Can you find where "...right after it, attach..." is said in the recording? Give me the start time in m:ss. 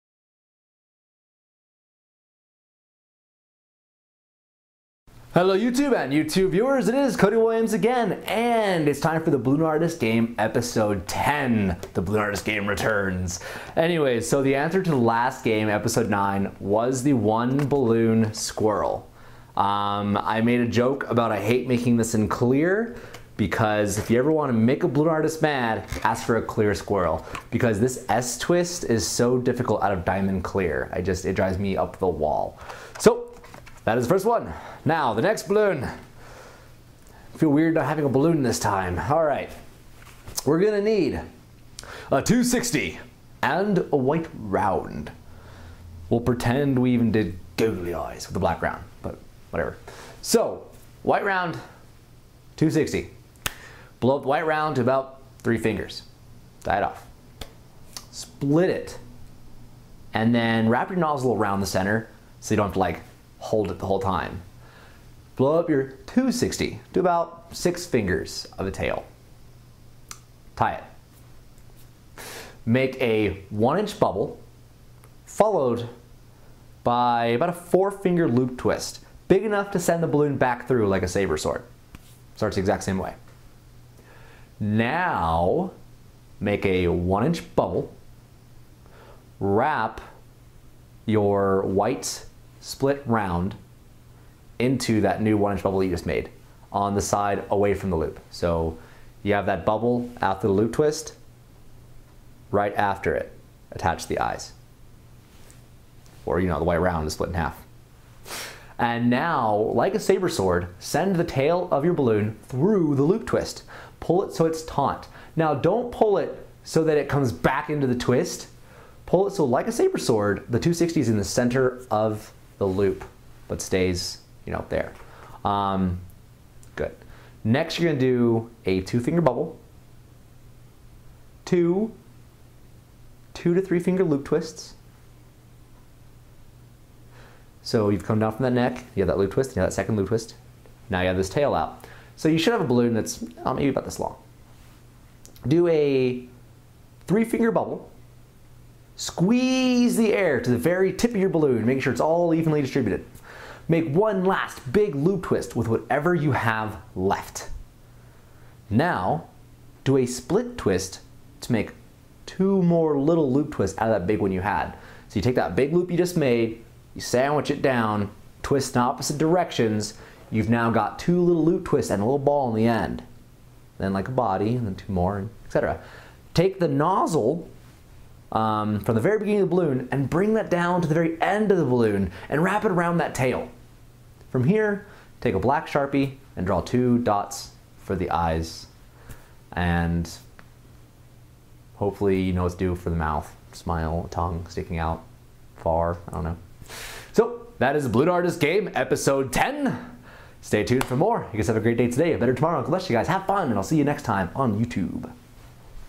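1:42.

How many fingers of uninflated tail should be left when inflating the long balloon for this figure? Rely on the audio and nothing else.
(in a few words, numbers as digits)
6.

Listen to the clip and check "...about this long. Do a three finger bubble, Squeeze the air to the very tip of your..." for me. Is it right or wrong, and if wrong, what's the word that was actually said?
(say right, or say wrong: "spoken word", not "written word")
right.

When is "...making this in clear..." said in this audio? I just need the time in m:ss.
0:21.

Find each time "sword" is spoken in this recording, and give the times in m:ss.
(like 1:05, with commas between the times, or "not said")
1:21, 1:50, 1:59.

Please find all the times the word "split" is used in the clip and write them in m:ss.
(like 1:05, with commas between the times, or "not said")
0:58, 1:32, 1:47, 2:40.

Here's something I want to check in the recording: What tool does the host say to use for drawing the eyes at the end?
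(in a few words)
black Sharpie.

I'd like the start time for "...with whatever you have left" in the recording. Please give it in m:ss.
2:35.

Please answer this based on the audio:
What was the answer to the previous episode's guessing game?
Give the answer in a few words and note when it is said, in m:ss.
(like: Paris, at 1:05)
one balloon squirrel, at 0:17.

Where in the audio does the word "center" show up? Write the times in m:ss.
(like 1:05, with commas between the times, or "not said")
1:01, 2:01.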